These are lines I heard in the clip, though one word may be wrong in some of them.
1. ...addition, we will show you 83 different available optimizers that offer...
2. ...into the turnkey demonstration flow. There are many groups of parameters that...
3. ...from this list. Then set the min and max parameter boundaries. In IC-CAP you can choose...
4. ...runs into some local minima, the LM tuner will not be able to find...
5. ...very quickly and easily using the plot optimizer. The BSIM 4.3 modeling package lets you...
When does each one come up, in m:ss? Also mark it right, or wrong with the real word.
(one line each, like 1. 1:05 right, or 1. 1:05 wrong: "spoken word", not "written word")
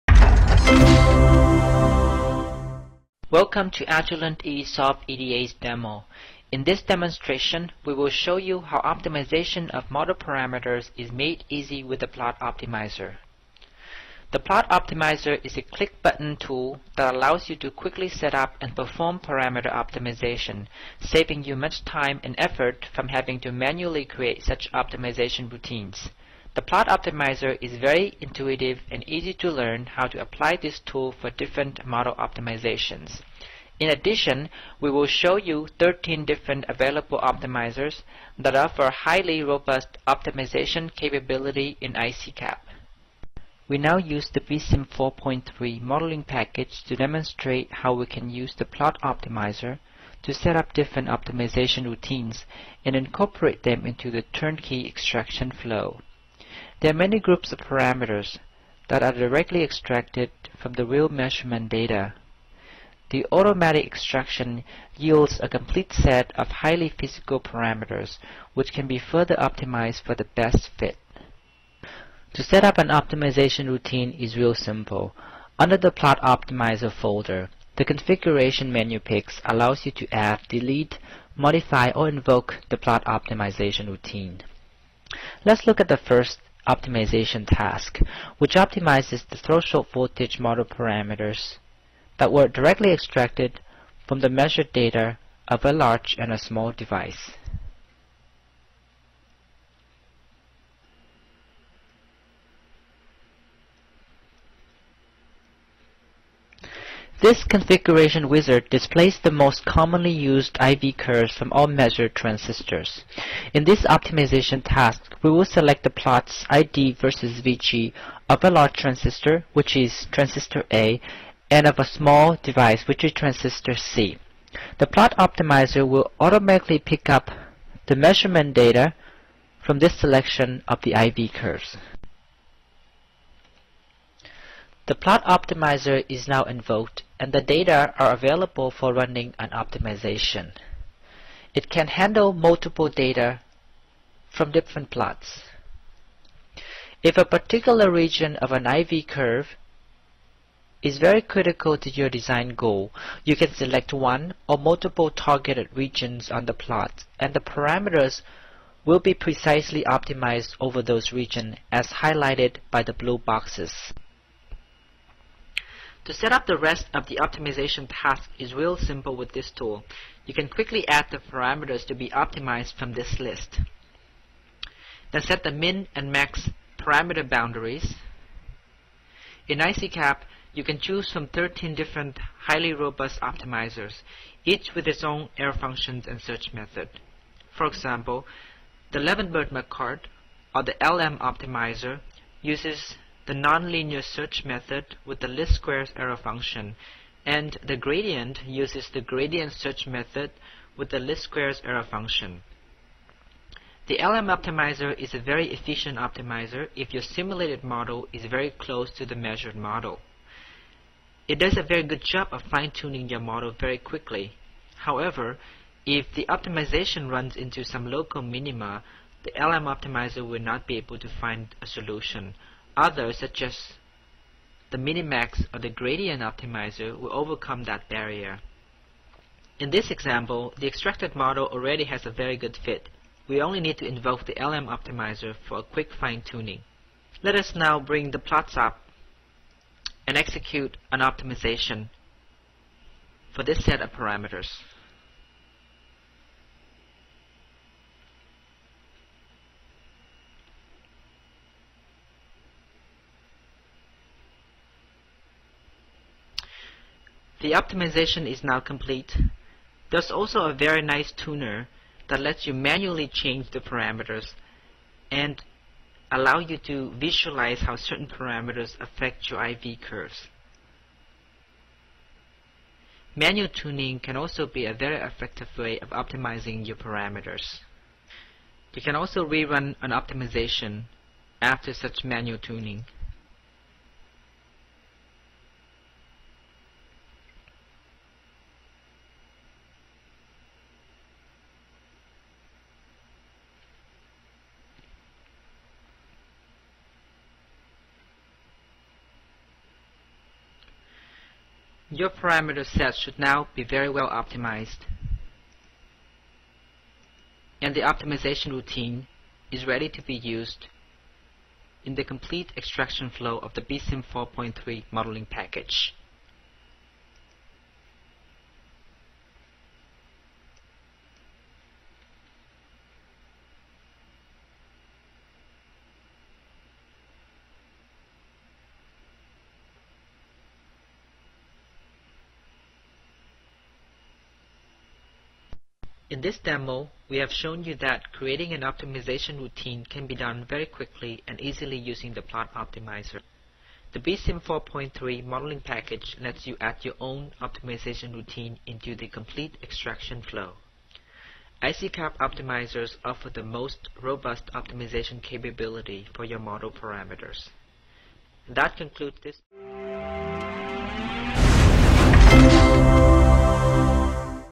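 1. 0:33 wrong: "13", not "83"
2. 0:53 wrong: "extraction", not "demonstration"
3. 2:52 right
4. 3:37 wrong: "optimizer", not "tuner"
5. 5:40 right.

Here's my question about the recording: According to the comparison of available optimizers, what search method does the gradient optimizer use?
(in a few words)
Gradient search method.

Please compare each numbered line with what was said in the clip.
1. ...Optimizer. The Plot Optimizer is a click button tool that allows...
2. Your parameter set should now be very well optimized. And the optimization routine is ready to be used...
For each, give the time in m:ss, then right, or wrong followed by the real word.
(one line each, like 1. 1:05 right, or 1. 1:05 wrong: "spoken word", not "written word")
1. 0:12 right
2. 5:02 right.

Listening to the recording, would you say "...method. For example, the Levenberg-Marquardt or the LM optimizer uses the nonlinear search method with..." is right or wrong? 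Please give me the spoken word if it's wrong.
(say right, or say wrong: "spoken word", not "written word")
right.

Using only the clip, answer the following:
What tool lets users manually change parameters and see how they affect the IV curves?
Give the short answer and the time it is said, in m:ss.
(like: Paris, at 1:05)
Tuner, at 4:21.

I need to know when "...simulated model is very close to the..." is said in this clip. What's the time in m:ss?
3:27.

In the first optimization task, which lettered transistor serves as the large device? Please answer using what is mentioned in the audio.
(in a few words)
Transistor A.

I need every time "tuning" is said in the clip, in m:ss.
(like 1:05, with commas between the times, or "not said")
3:32, 3:55, 4:33, 4:42.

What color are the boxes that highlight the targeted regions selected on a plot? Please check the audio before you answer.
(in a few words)
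Blue.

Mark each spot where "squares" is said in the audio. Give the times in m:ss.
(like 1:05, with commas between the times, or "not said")
3:15, 3:21.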